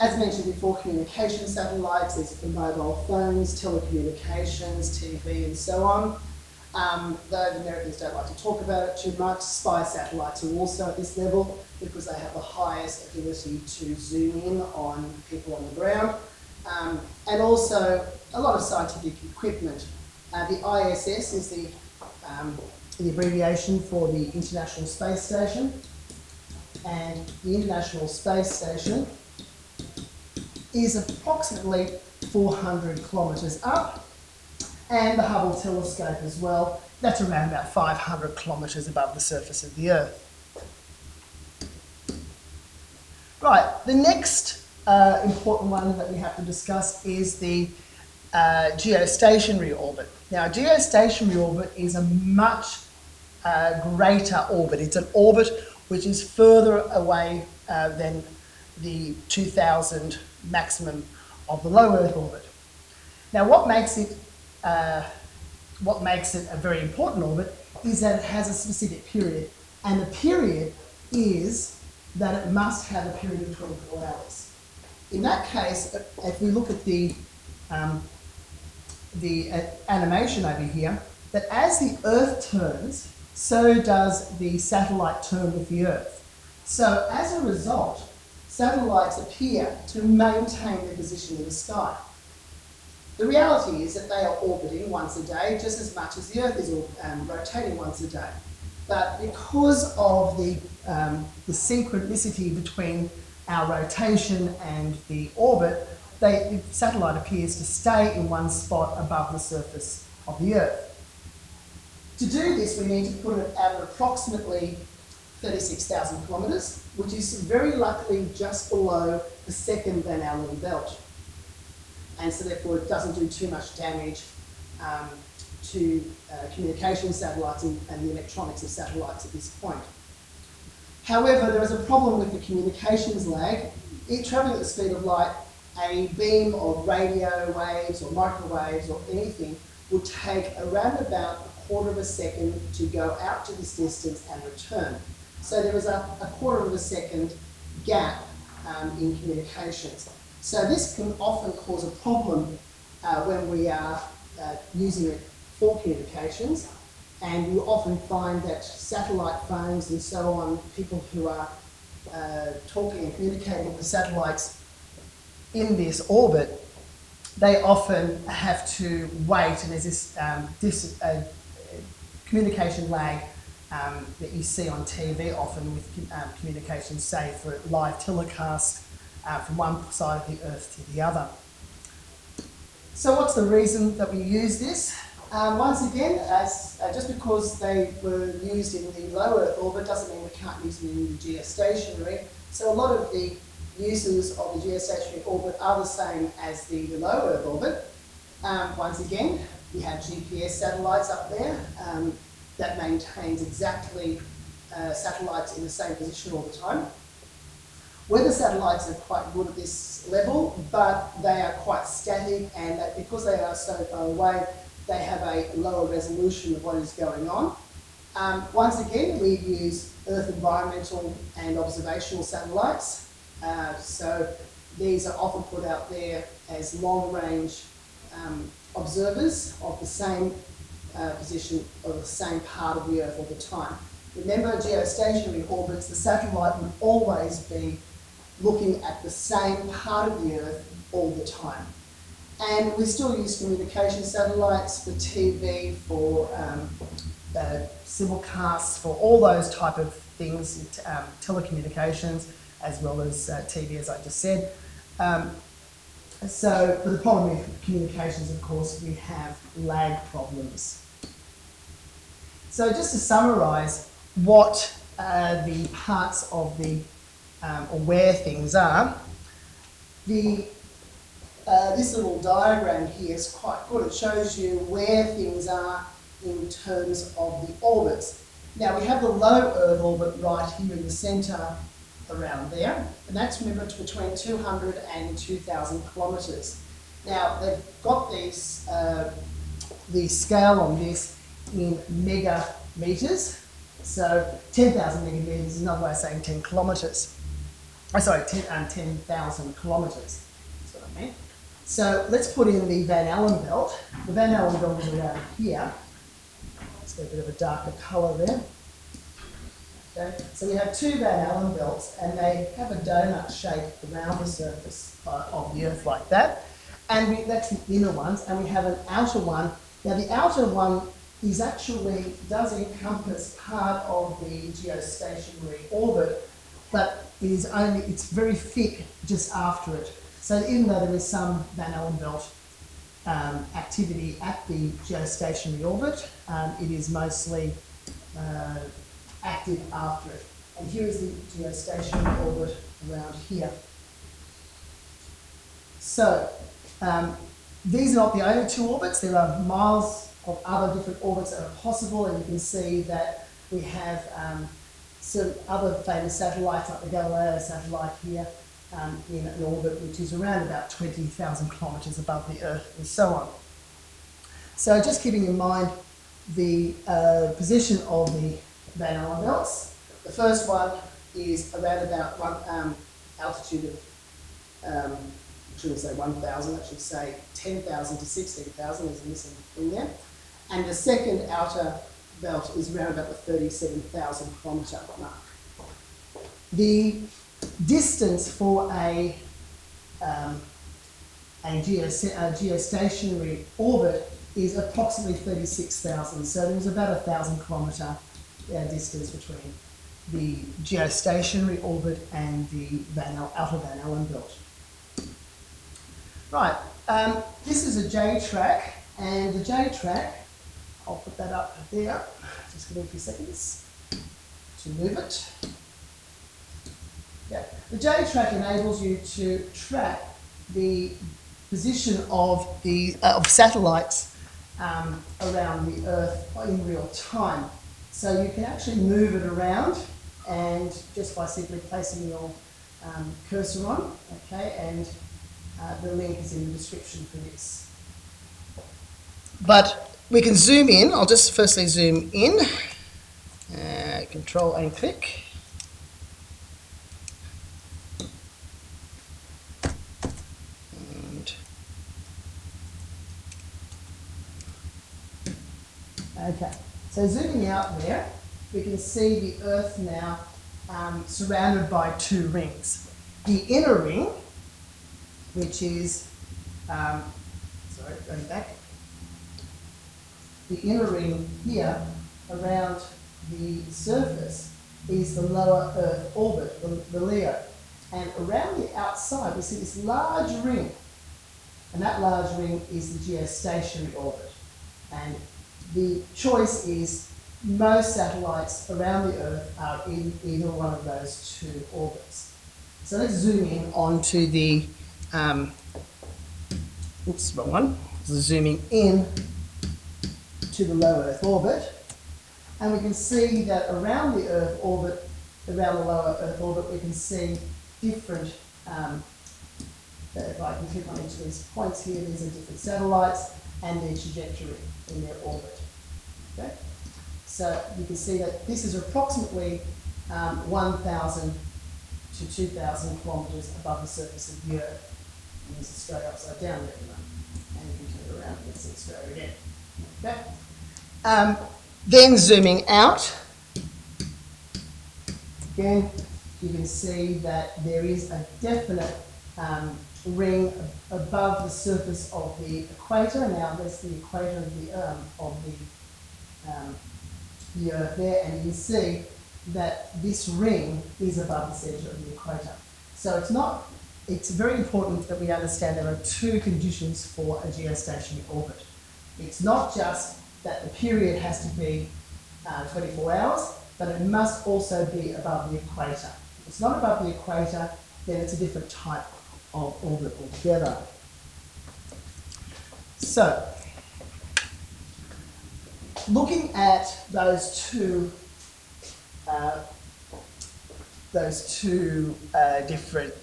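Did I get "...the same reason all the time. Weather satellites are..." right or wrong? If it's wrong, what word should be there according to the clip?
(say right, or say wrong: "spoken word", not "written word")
wrong: "position", not "reason".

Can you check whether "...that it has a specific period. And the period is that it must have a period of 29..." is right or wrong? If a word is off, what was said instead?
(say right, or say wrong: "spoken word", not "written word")
wrong: "24", not "29".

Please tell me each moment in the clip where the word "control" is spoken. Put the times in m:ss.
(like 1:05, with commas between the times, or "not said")
7:24.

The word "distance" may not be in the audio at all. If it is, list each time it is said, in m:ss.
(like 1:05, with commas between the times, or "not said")
2:23, 6:27, 6:38.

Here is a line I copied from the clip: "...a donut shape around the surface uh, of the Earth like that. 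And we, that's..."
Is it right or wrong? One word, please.
right.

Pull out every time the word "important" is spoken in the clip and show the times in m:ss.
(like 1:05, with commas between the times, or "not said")
0:45, 1:06, 9:14.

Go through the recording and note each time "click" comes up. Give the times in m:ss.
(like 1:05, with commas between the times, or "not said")
7:24, 8:30.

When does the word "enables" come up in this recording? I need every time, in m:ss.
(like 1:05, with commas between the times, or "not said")
6:58.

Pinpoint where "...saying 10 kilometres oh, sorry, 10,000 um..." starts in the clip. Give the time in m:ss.
4:55.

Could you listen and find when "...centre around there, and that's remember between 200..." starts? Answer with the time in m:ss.
4:40.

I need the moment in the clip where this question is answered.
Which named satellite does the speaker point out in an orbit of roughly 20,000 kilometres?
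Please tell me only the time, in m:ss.
5:56.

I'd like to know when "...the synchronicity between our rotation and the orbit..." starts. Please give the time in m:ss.
1:41.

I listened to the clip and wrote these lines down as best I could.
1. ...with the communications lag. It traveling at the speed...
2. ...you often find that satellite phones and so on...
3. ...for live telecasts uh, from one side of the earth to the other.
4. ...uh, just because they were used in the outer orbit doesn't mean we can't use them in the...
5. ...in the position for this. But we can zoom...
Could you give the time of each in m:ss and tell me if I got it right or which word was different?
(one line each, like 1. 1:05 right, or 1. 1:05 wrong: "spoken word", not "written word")
1. 2:12 right
2. 2:37 right
3. 2:57 right
4. 3:06 wrong: "lower", not "outer"
5. 7:16 wrong: "description", not "position".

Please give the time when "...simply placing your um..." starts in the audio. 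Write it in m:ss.
7:11.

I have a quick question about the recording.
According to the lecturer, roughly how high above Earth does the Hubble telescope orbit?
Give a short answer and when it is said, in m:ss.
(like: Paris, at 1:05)
500 kilometres, at 0:37.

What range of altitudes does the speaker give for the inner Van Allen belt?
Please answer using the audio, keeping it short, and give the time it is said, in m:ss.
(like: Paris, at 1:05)
10,000 to 16,000 kilometres, at 6:17.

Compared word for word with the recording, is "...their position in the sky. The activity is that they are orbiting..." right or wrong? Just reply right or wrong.
wrong.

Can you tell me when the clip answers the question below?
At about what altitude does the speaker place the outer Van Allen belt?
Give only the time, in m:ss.
6:23.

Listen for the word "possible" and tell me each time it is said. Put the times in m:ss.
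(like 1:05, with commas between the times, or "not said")
5:51.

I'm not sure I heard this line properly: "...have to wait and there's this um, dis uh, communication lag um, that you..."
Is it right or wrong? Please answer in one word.
right.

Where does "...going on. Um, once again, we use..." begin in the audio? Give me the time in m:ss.
3:36.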